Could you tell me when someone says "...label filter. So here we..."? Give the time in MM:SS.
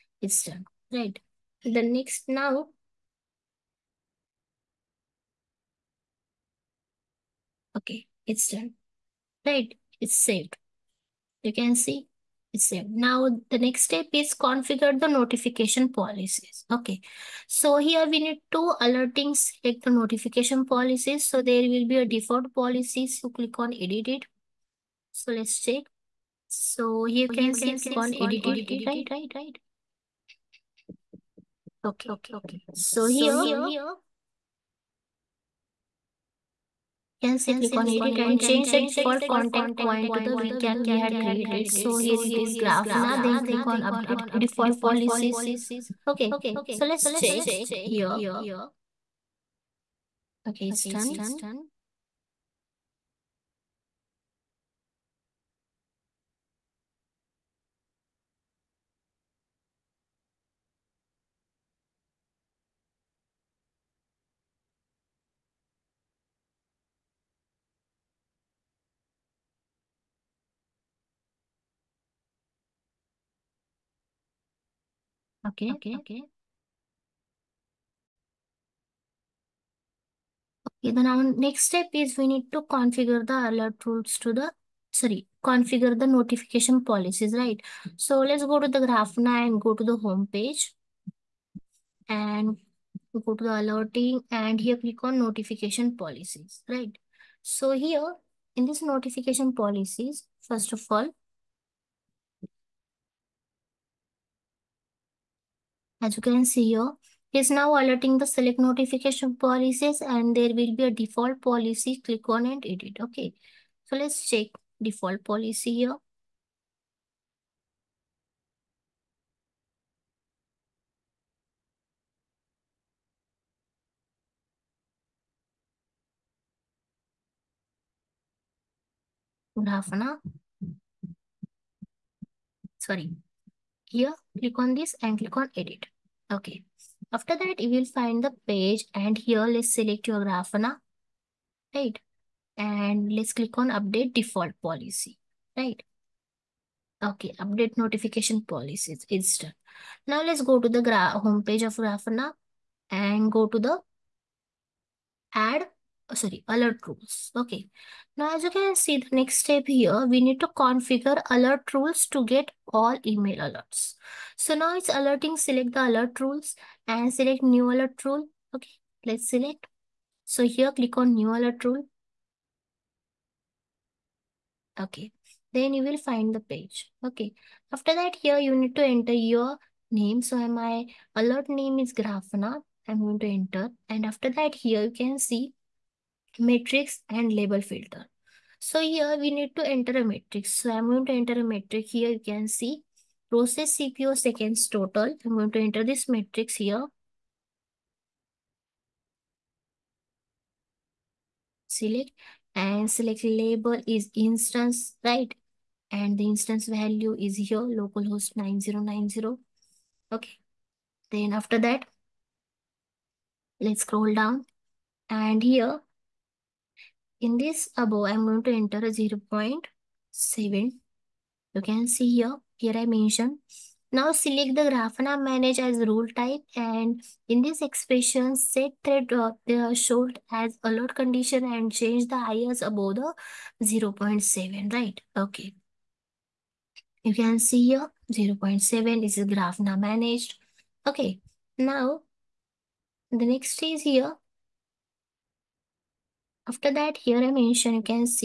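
03:07.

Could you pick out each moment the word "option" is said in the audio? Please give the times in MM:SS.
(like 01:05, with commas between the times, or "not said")
not said.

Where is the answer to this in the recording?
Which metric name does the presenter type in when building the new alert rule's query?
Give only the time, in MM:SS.
03:13.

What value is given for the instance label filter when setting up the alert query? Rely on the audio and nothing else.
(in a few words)
localhost 9090.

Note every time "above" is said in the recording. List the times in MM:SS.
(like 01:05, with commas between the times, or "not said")
03:37, 03:52.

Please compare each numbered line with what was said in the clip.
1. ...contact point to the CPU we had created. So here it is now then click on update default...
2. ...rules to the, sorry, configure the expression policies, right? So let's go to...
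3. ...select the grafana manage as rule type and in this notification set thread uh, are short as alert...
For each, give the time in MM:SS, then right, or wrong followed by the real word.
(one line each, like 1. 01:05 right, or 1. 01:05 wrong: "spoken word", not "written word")
1. 00:39 wrong: "VCAN", not "CPU"
2. 01:23 wrong: "notification", not "expression"
3. 03:44 wrong: "expression", not "notification".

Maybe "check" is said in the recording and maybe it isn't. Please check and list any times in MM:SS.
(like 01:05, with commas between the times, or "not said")
00:25, 00:47, 01:54.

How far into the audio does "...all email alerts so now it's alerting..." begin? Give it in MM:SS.
02:42.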